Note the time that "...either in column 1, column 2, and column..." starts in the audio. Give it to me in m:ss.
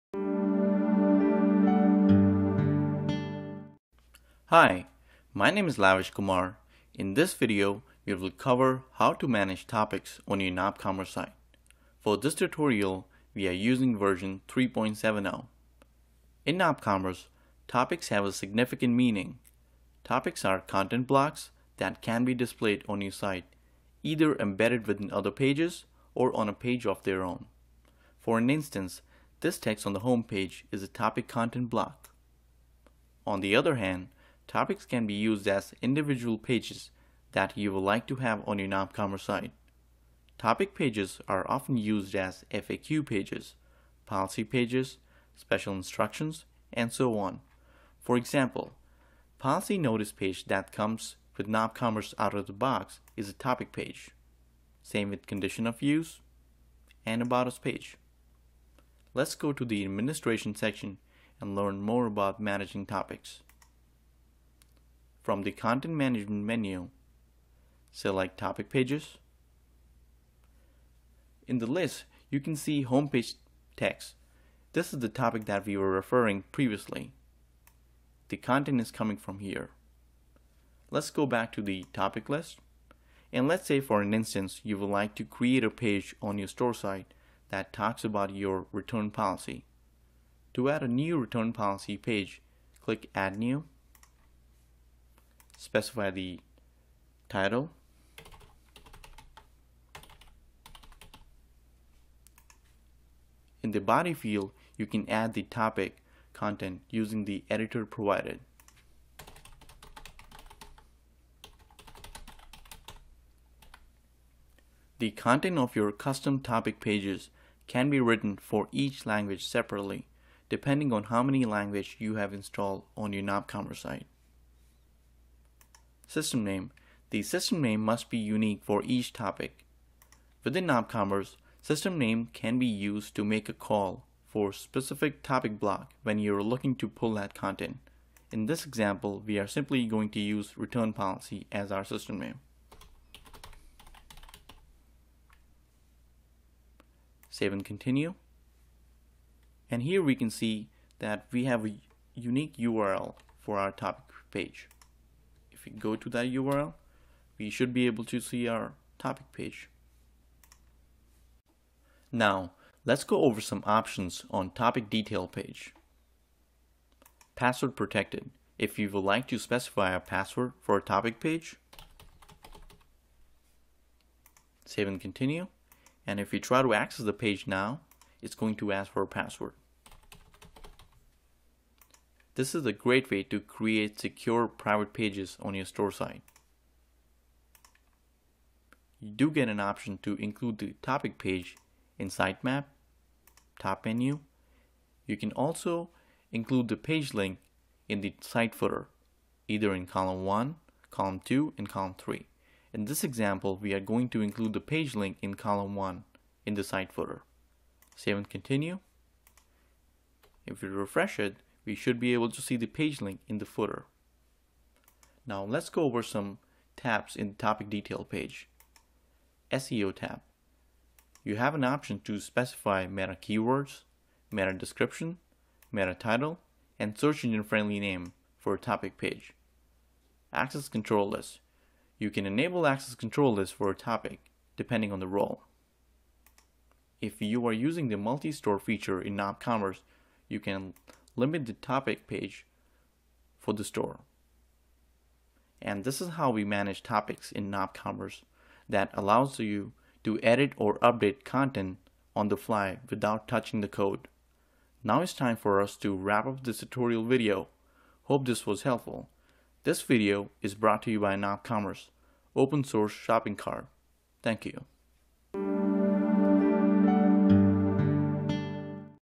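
3:19.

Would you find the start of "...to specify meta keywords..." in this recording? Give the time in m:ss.
3:42.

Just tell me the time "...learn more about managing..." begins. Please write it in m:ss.
1:01.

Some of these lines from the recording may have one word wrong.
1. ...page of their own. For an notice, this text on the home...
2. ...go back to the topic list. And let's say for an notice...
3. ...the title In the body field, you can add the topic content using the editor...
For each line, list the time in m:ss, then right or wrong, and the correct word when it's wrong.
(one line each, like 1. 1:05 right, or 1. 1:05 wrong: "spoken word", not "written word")
1. 0:26 wrong: "instance", not "notice"
2. 1:21 wrong: "instance", not "notice"
3. 1:36 right.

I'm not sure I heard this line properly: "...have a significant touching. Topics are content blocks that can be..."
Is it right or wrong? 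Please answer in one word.
wrong.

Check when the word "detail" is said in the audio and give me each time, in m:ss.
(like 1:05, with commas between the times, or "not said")
2:44, 3:37.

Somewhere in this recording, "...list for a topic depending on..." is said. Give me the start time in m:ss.
3:53.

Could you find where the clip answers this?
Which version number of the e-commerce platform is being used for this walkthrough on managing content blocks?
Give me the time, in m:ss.
0:14.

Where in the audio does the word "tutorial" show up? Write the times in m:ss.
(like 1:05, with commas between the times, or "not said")
0:12, 4:16.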